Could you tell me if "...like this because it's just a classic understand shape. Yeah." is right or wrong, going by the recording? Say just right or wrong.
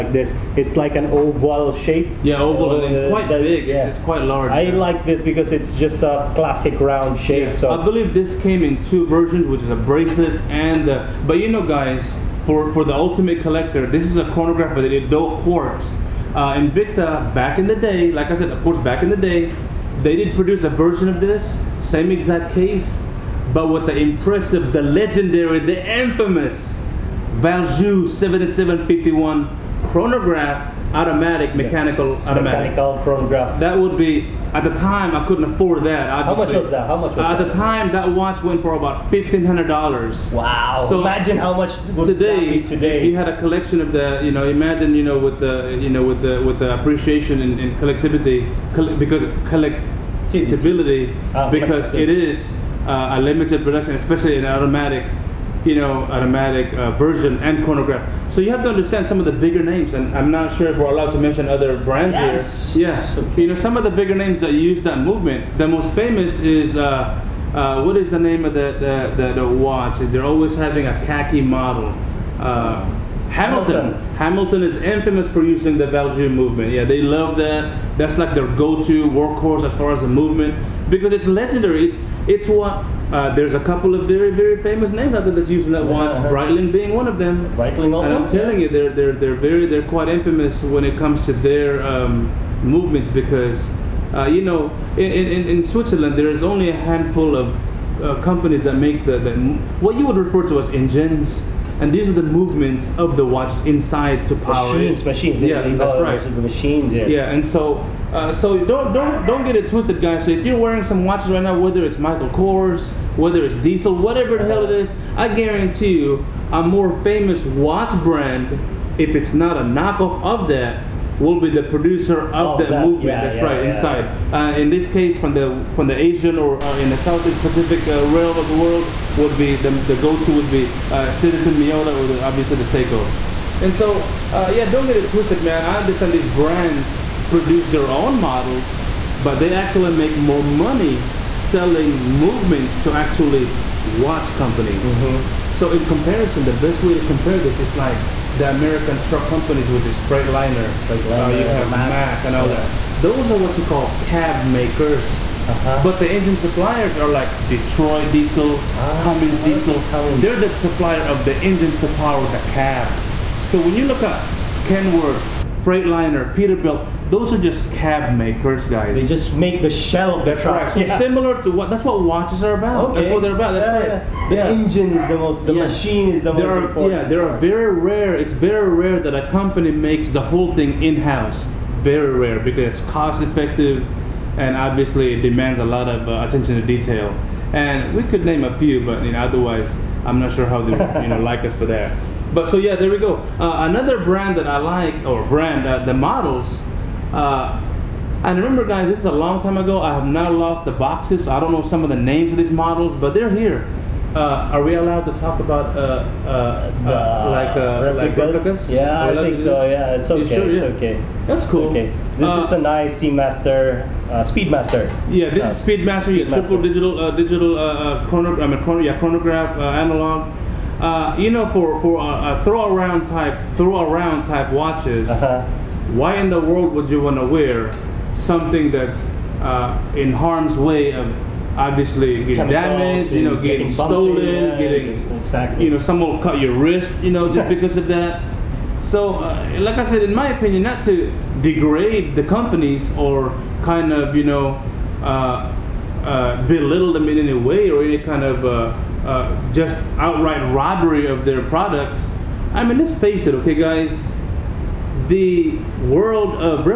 wrong.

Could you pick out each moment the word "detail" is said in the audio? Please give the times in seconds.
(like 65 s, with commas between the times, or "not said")
186 s.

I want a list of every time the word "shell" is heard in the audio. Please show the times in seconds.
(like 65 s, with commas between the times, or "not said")
169 s.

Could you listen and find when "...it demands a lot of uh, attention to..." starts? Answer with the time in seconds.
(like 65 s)
185 s.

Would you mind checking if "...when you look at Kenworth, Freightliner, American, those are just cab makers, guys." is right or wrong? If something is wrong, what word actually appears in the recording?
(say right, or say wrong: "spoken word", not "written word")
wrong: "Peterbilt", not "American".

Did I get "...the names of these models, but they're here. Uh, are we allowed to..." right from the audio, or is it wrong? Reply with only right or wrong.
right.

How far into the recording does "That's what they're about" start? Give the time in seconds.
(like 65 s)
173 s.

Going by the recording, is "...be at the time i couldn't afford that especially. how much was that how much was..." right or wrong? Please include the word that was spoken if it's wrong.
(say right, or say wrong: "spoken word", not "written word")
wrong: "obviously", not "especially".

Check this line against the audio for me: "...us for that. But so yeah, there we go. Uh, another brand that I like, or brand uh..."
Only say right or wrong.
right.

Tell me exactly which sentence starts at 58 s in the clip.
So you have to understand some of the bigger names, and I'm not sure if we're allowed to mention other brands yes.